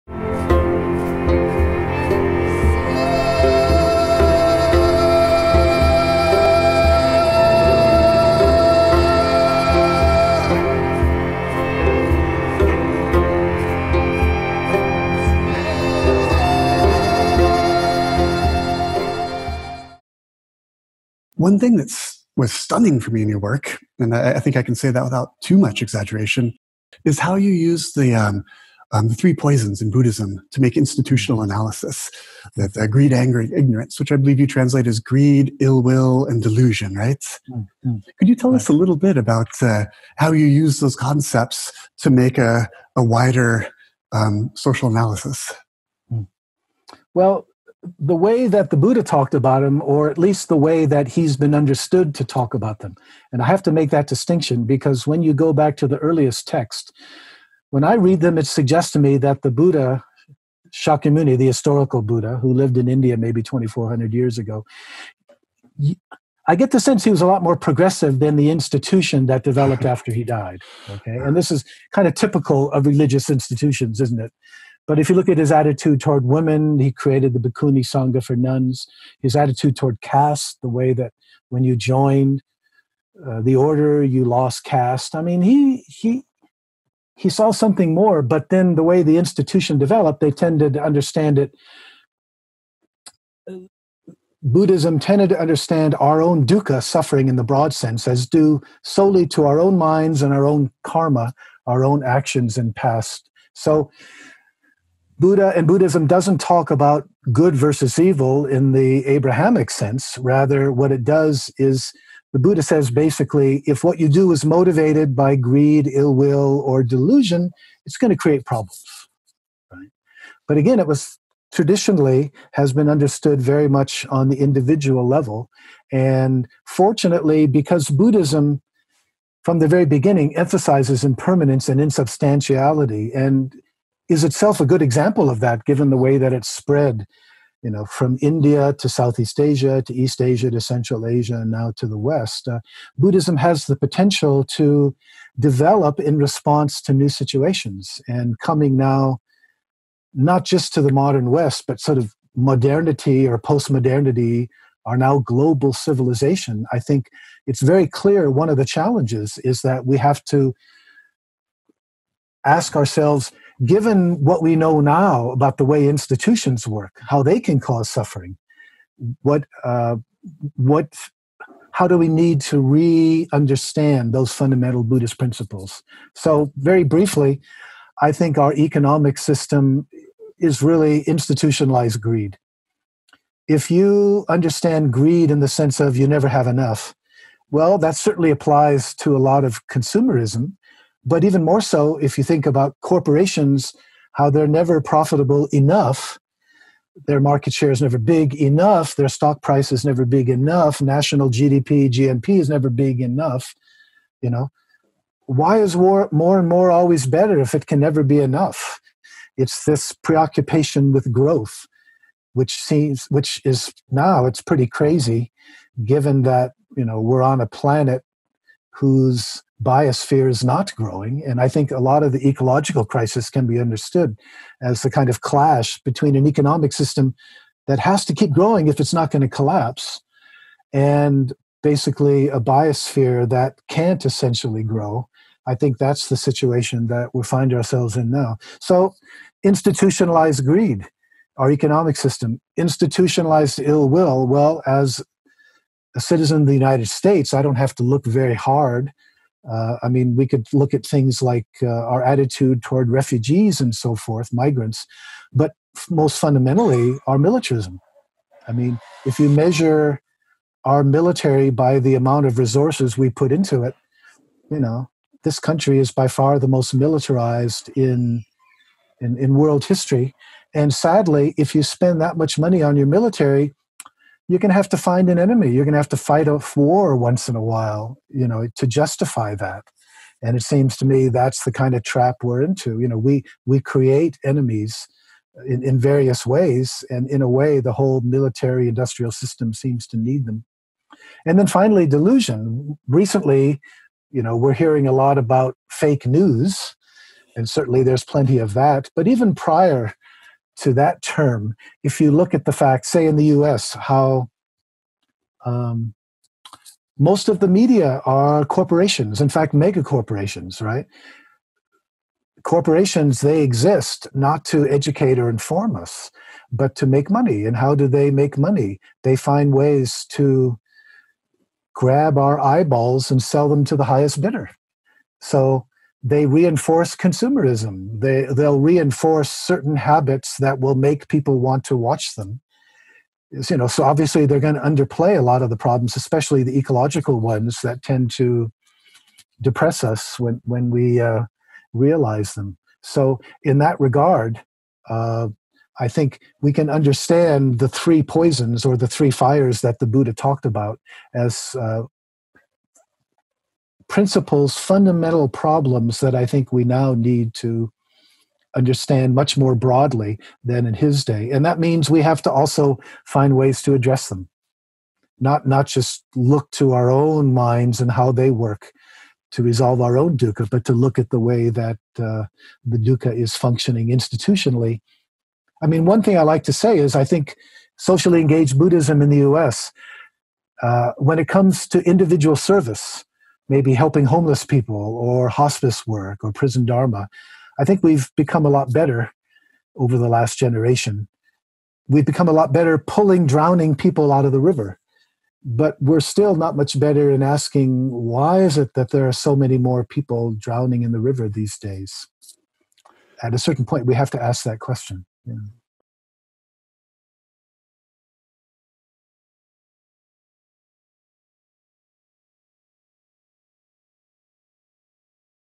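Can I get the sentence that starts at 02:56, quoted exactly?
So, very briefly, I think our economic system is really institutionalized greed.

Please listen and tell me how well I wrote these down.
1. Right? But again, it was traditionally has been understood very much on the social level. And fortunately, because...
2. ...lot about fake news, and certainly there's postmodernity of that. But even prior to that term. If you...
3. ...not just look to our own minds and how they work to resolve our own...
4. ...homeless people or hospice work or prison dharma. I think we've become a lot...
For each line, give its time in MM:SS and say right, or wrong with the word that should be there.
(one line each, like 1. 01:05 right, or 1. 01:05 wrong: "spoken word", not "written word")
1. 01:59 wrong: "individual", not "social"
2. 04:54 wrong: "plenty", not "postmodernity"
3. 06:05 right
4. 06:24 right.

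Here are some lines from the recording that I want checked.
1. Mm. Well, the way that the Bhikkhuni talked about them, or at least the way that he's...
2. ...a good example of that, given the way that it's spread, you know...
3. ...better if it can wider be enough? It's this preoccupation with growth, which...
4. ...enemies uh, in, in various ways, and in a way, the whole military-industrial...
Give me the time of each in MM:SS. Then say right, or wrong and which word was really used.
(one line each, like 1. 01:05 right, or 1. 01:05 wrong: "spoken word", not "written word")
1. 00:46 wrong: "Buddha", not "Bhikkhuni"
2. 02:14 right
3. 03:27 wrong: "never", not "wider"
4. 04:44 right.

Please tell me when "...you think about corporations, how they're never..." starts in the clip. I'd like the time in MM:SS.
03:12.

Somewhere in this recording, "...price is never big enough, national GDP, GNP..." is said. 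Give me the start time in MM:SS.
03:19.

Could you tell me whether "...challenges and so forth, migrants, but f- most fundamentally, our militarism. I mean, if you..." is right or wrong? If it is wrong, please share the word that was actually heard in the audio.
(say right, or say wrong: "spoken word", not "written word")
wrong: "refugees", not "challenges".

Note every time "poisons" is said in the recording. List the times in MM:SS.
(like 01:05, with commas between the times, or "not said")
00:29, 05:48.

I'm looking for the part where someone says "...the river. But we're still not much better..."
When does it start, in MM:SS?
06:34.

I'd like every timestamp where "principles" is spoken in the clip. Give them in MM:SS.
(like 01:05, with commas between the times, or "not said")
02:55, 05:53.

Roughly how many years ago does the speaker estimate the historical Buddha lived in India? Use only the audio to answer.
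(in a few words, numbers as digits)
2,400 years.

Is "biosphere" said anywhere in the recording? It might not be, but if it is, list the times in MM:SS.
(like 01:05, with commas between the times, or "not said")
03:39, 03:52.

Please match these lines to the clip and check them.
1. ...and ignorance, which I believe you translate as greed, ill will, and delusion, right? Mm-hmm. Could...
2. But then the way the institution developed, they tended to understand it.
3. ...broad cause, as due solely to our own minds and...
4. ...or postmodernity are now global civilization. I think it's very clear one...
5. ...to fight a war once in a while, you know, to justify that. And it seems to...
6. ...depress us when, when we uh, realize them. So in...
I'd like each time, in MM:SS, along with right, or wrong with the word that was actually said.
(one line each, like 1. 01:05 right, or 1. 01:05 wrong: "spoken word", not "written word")
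1. 00:33 right
2. 01:28 right
3. 01:37 wrong: "sense", not "cause"
4. 02:33 right
5. 04:35 right
6. 05:39 right.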